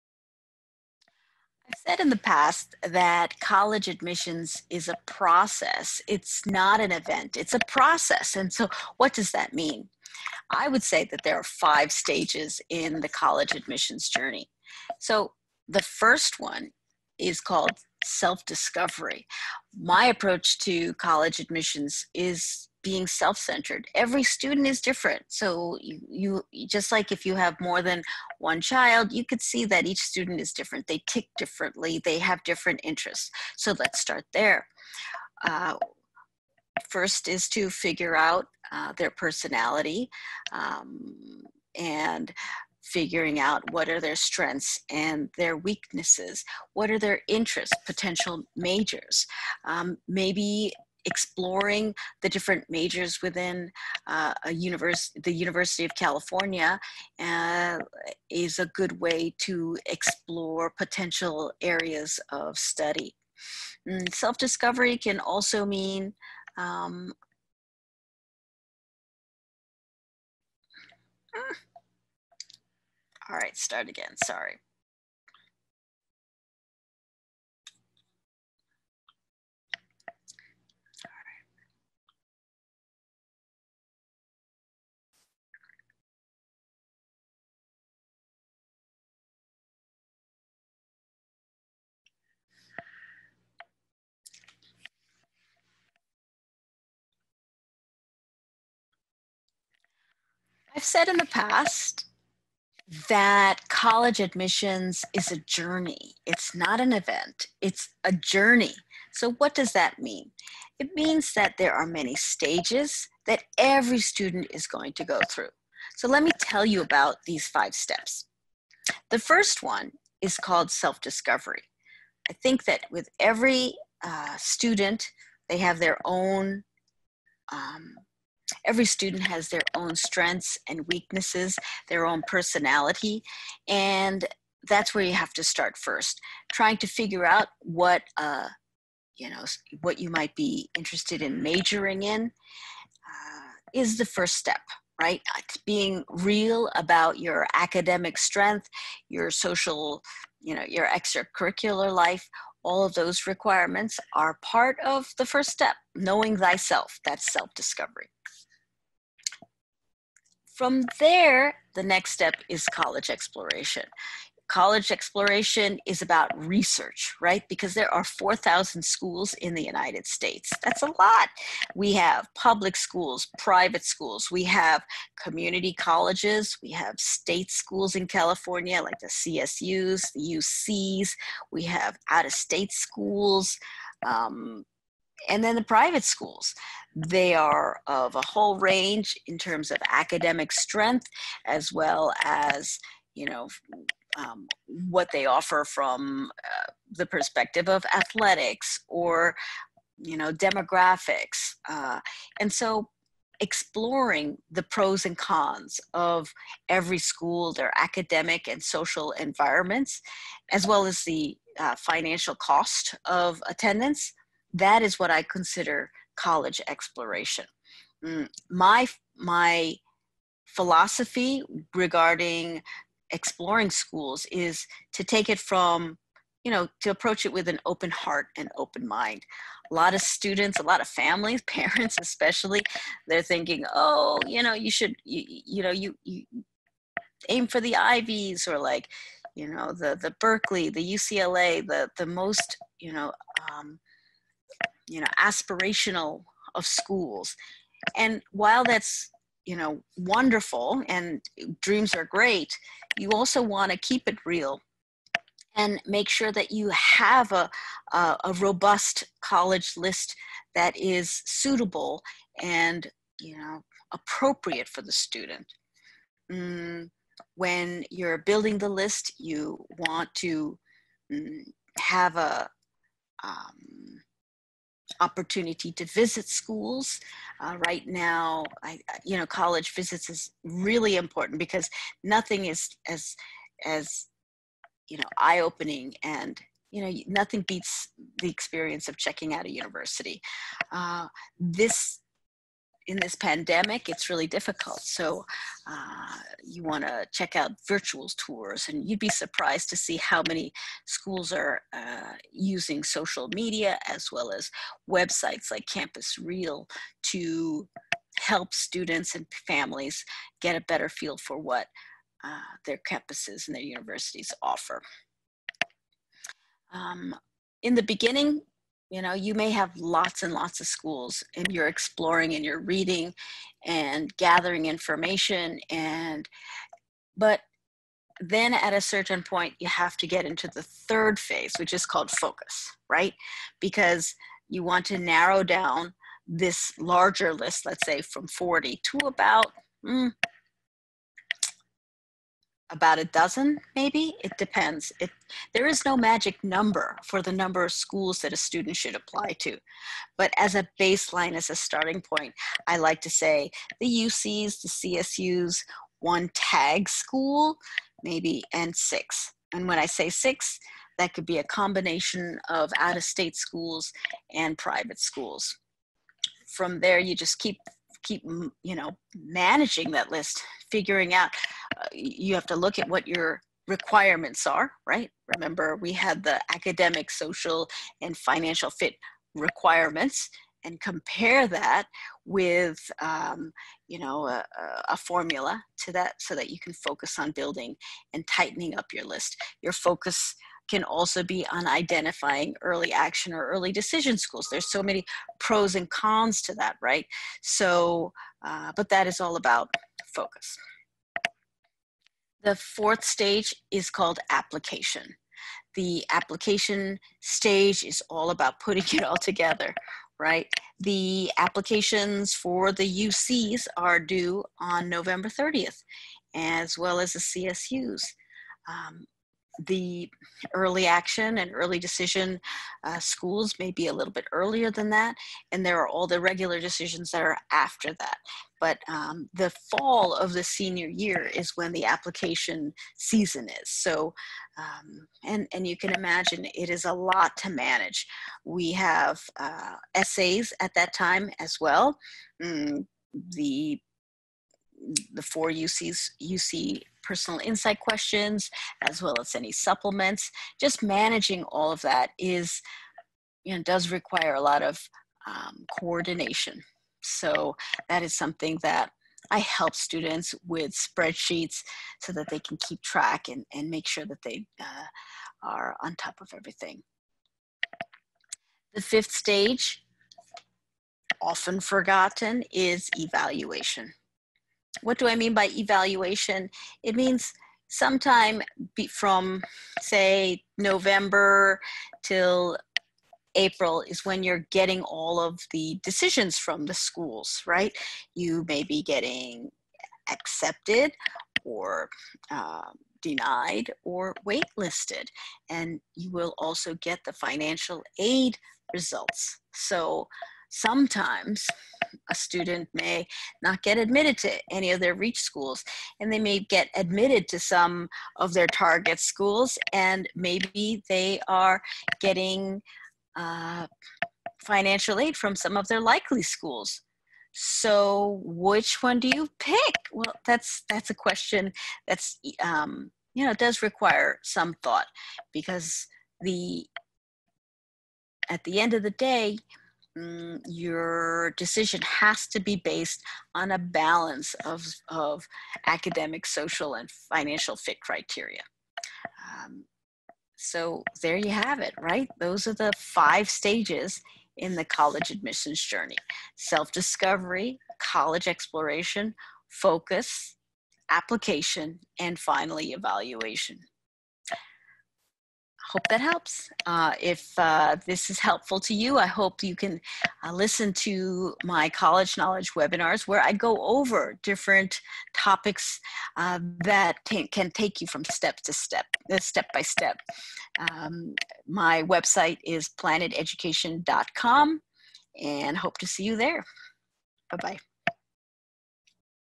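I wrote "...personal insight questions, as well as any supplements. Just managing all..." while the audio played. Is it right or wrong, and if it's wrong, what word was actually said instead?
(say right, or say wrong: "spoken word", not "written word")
right.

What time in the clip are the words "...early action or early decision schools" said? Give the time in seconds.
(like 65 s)
392 s.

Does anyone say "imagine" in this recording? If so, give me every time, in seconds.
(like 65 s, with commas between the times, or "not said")
435 s.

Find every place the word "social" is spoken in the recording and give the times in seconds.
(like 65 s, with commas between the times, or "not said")
149 s, 208 s, 302 s, 377 s, 536 s.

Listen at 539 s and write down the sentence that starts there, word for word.
Um, so there you have it, right?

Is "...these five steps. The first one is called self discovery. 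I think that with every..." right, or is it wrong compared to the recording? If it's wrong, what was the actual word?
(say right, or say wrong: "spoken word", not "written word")
right.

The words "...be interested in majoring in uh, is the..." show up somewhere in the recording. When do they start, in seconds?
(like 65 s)
140 s.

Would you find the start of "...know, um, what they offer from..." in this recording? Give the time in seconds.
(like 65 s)
193 s.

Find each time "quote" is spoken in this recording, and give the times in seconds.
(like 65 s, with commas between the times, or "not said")
not said.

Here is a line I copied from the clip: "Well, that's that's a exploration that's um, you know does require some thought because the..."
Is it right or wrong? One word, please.
wrong.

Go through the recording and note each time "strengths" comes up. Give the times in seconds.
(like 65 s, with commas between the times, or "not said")
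44 s, 129 s, 148 s, 190 s.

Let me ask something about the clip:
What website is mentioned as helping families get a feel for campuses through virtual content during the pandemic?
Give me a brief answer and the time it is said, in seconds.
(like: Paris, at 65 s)
CampusReel, at 305 s.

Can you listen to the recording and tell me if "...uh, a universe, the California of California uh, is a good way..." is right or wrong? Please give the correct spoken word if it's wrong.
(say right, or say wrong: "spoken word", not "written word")
wrong: "University", not "California".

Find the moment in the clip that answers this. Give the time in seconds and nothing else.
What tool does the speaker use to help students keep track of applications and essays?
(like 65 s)
460 s.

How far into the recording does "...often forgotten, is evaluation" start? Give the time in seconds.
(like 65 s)
471 s.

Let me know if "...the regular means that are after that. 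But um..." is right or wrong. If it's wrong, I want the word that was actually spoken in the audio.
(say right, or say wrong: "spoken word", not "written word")
wrong: "decisions", not "means".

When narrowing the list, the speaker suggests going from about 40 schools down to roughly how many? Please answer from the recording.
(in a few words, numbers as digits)
a dozen.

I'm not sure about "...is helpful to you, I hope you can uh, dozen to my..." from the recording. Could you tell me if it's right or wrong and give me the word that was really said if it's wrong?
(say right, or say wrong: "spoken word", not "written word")
wrong: "listen", not "dozen".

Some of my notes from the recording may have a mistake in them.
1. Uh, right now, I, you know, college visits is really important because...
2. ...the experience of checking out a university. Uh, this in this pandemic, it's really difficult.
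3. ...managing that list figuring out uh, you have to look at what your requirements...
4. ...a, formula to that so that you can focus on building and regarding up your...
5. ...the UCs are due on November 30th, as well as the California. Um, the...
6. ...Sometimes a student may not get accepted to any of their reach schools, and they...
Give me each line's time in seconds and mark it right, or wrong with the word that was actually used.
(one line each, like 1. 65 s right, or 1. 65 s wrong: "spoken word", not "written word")
1. 277 s right
2. 288 s right
3. 369 s right
4. 384 s wrong: "tightening", not "regarding"
5. 412 s wrong: "CSUs", not "California"
6. 500 s wrong: "admitted", not "accepted".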